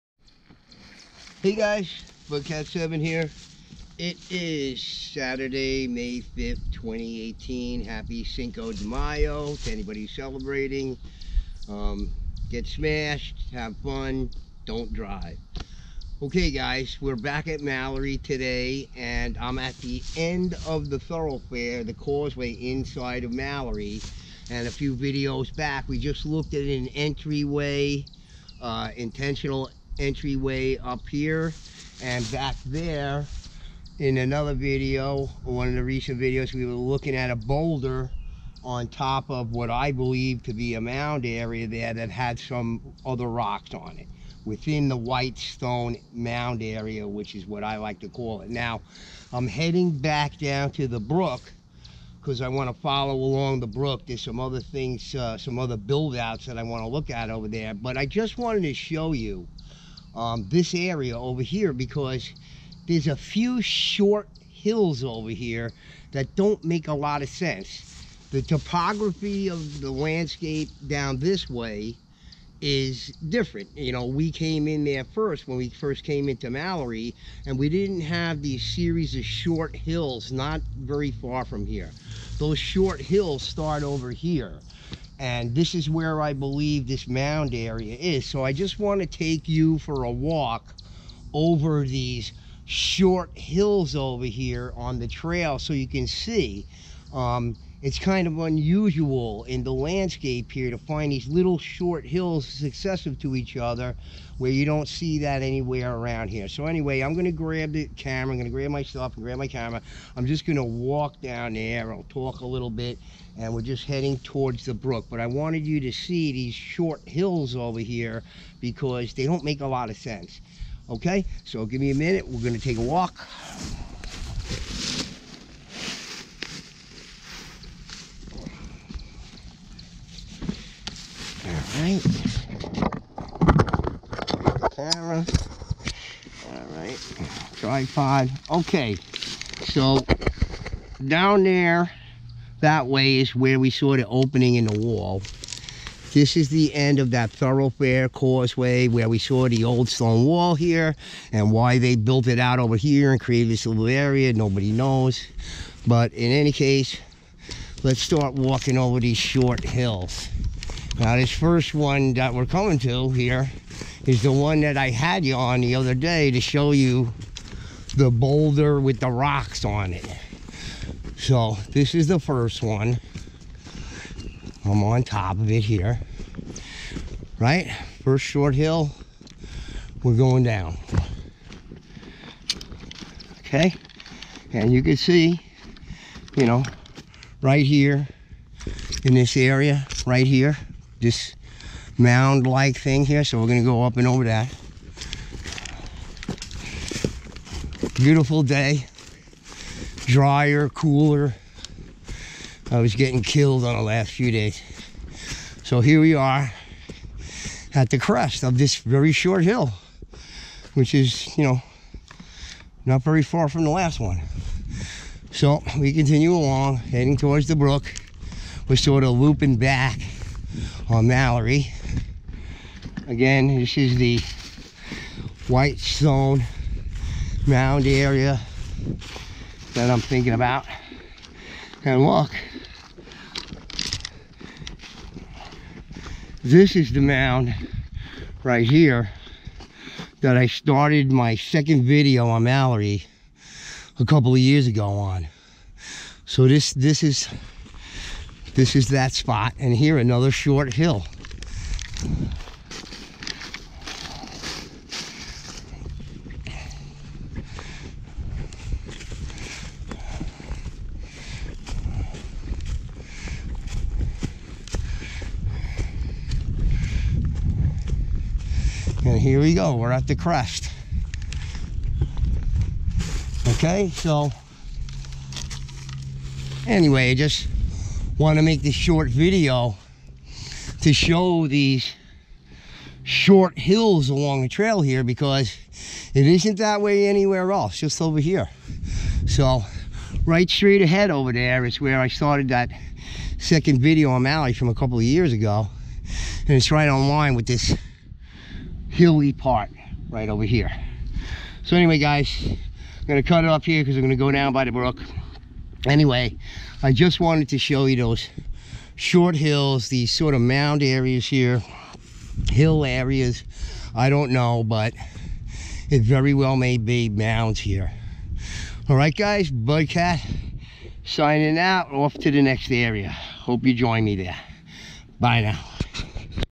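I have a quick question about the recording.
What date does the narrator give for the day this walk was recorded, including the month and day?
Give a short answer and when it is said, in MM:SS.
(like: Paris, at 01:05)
May 5th, at 00:05.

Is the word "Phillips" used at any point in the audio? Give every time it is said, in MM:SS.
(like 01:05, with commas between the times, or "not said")
not said.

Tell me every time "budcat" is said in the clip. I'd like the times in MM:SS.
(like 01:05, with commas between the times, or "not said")
00:02, 05:19.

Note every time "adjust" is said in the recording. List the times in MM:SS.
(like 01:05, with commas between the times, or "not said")
not said.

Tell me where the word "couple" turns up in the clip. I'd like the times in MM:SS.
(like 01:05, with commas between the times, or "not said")
04:04, 04:54.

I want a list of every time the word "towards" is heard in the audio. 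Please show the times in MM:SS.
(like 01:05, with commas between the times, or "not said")
01:54, 03:37.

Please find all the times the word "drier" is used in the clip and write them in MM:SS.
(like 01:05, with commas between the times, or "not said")
03:20.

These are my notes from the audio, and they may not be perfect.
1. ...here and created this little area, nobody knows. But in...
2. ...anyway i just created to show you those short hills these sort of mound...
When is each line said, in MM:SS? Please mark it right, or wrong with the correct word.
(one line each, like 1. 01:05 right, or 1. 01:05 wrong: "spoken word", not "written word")
1. 02:32 right
2. 05:05 wrong: "wanted", not "created".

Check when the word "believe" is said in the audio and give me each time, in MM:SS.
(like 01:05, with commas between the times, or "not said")
00:39, 01:26.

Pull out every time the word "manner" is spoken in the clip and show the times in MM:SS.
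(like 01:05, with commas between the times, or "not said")
not said.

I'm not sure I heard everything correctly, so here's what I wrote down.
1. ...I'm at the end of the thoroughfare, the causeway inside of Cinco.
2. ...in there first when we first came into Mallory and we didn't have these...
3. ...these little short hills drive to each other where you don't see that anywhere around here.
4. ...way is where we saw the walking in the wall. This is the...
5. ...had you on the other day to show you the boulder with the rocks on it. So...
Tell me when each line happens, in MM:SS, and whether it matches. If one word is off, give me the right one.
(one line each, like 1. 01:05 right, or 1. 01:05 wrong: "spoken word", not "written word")
1. 00:19 wrong: "Mallory", not "Cinco"
2. 01:14 right
3. 01:41 wrong: "successive", not "drive"
4. 02:22 wrong: "opening", not "walking"
5. 02:44 right.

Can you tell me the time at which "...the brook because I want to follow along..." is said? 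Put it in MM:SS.
00:50.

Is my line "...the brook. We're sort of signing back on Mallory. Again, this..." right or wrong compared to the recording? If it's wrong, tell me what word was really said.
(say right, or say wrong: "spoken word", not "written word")
wrong: "looping", not "signing".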